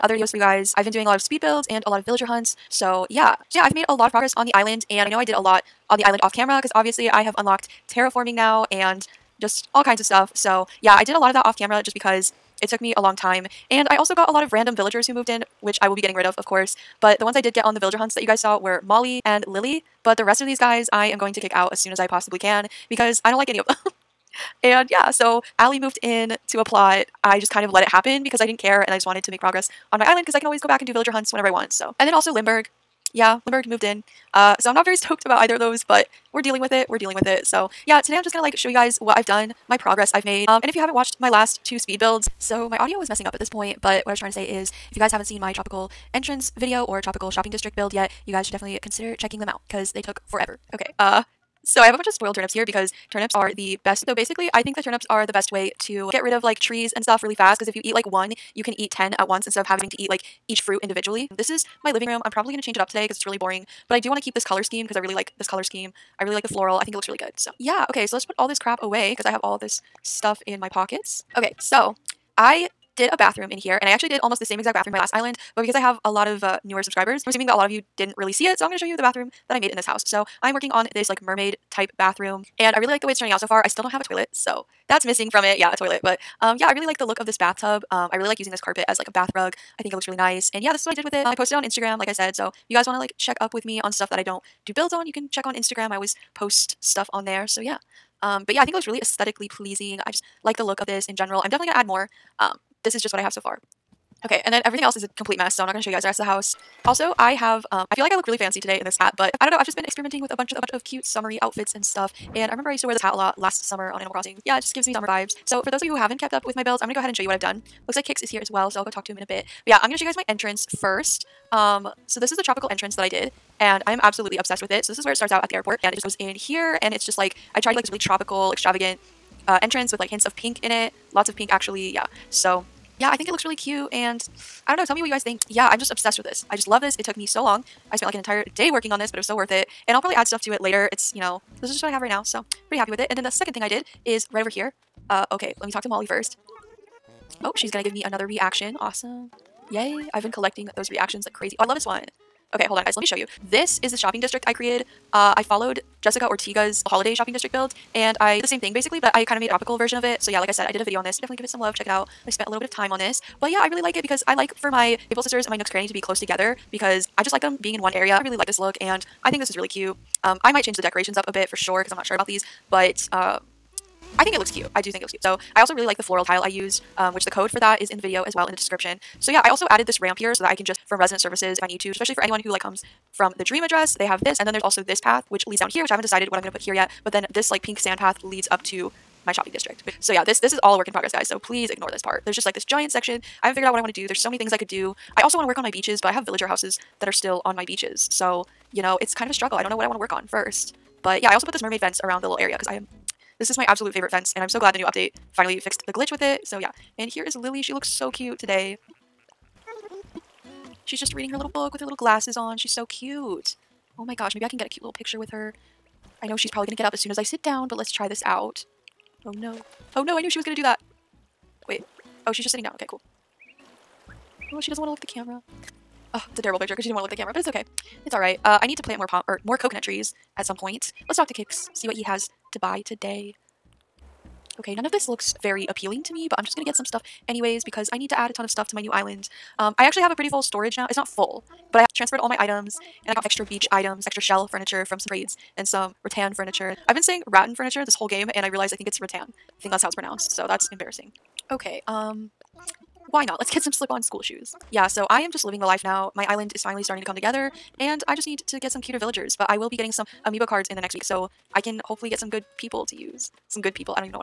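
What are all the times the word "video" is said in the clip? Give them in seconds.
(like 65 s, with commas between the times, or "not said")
0 s, 46 s, 160 s, 178 s.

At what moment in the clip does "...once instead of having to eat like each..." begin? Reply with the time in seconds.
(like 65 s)
59 s.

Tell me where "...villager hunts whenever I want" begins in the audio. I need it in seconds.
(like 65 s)
30 s.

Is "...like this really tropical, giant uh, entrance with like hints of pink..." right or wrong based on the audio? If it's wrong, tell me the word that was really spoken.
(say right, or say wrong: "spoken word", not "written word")
wrong: "extravagant", not "giant".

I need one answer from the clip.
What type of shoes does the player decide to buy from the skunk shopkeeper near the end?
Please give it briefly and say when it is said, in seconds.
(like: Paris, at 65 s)
Slip-on school shoes, at 253 s.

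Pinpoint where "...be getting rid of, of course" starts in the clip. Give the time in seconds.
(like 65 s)
15 s.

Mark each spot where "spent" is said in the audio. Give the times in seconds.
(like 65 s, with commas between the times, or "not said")
137 s, 162 s.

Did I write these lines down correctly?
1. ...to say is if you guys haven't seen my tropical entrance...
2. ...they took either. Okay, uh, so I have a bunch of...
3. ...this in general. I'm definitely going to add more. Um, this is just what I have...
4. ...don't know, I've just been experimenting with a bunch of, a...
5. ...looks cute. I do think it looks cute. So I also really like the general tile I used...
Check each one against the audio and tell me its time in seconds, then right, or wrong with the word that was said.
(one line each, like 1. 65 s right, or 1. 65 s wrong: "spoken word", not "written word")
1. 44 s right
2. 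49 s wrong: "forever", not "either"
3. 100 s right
4. 109 s right
5. 174 s wrong: "floral", not "general".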